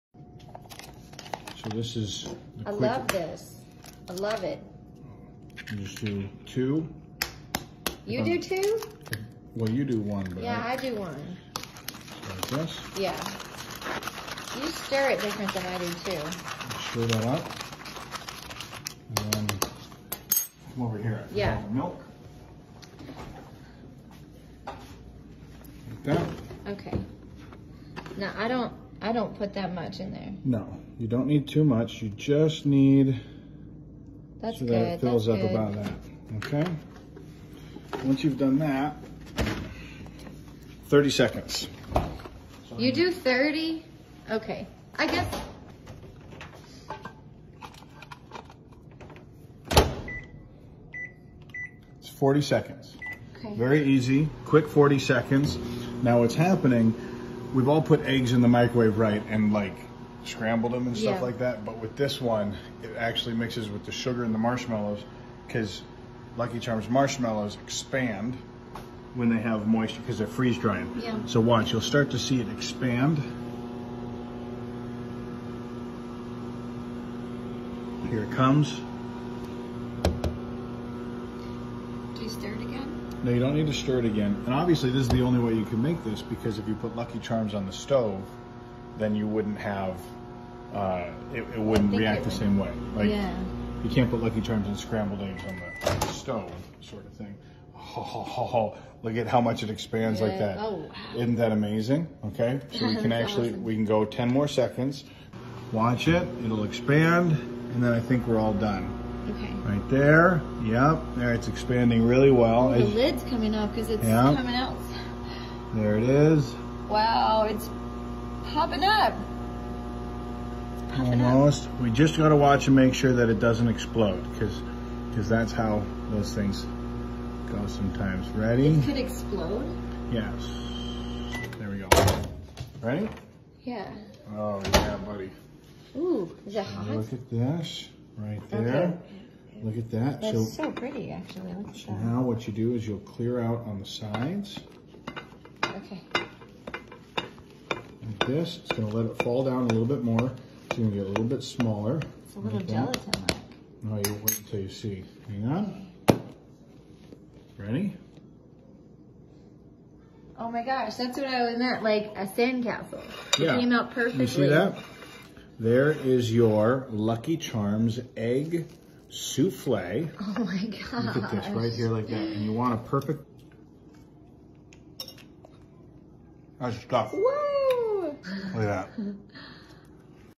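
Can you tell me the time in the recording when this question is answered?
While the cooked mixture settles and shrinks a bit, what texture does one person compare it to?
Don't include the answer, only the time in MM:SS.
02:32.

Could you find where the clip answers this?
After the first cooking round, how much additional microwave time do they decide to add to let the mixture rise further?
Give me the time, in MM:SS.
01:44.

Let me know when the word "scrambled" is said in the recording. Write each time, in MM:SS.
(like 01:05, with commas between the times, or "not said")
01:00, 01:34.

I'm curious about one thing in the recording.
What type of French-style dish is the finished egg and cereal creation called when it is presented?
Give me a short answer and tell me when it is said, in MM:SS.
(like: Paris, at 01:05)
souffle, at 02:49.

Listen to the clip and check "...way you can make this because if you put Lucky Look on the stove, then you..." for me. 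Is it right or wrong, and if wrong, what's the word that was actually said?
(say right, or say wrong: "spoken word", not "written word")
wrong: "Charms", not "Look".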